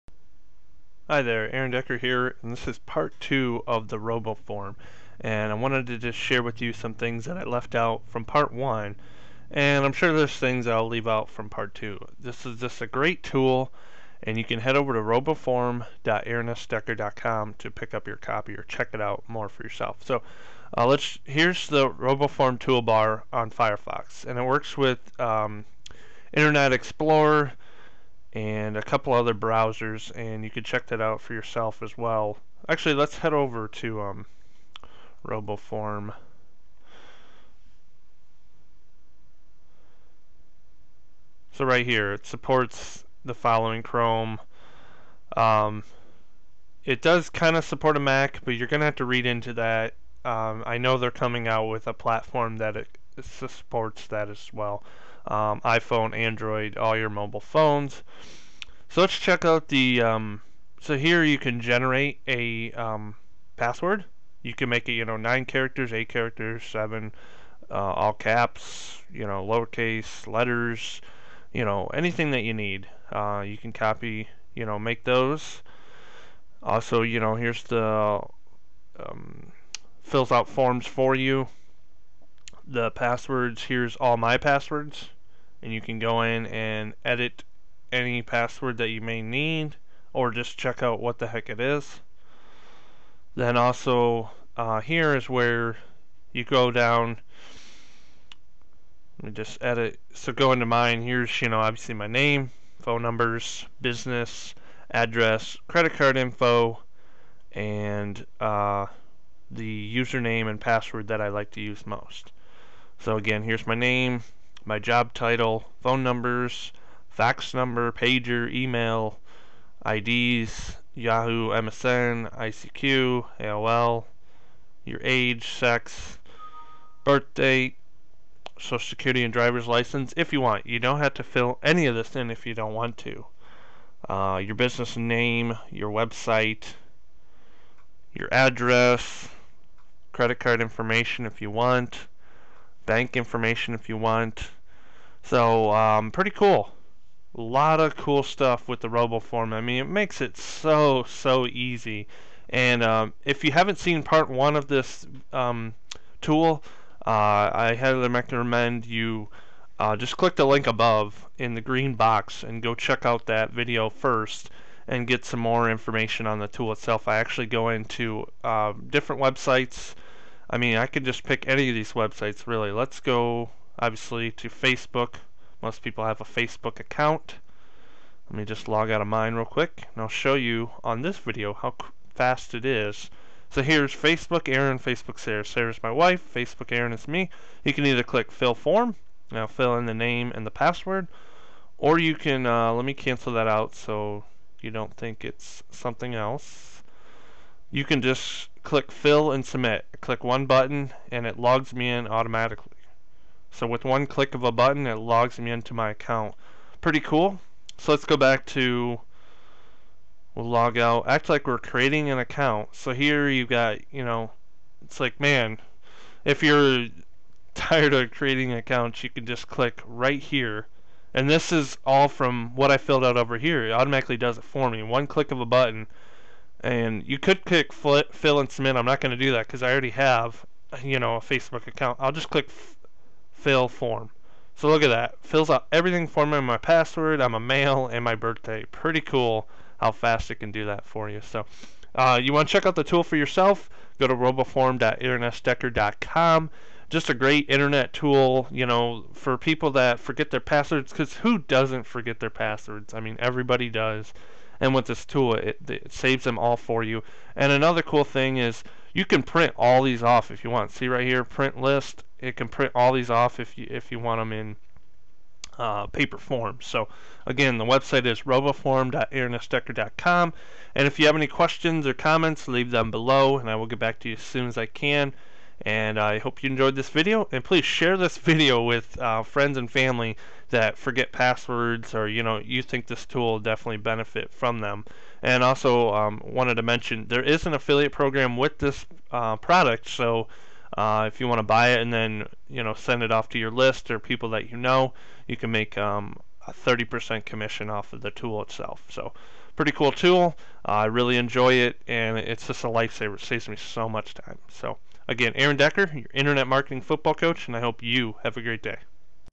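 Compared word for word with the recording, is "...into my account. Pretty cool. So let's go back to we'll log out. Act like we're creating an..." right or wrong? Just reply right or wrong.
right.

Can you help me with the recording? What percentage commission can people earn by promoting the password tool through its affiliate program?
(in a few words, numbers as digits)
30%.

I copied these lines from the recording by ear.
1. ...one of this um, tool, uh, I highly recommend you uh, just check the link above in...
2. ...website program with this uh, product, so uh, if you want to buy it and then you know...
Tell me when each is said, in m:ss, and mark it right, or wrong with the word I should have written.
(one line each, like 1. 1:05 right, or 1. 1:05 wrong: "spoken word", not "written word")
1. 2:34 wrong: "click", not "check"
2. 4:47 wrong: "affiliate", not "website".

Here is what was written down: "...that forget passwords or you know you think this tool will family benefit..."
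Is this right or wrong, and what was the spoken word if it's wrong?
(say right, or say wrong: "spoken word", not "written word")
wrong: "definitely", not "family".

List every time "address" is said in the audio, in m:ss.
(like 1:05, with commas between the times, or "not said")
1:44, 2:18.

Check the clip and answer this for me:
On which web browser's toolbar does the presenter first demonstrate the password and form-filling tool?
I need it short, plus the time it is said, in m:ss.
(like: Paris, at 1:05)
Firefox, at 0:23.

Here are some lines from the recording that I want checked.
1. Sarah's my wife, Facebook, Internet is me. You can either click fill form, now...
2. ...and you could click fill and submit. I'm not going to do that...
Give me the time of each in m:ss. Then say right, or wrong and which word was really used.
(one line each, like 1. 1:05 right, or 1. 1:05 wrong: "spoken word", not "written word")
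1. 3:05 wrong: "Aaron", not "Internet"
2. 3:46 right.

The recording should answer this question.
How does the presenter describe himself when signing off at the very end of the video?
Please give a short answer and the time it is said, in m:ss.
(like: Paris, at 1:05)
internet marketing football coach, at 5:06.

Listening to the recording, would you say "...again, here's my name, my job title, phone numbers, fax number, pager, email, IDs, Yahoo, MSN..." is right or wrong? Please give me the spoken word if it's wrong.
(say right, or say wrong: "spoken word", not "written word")
right.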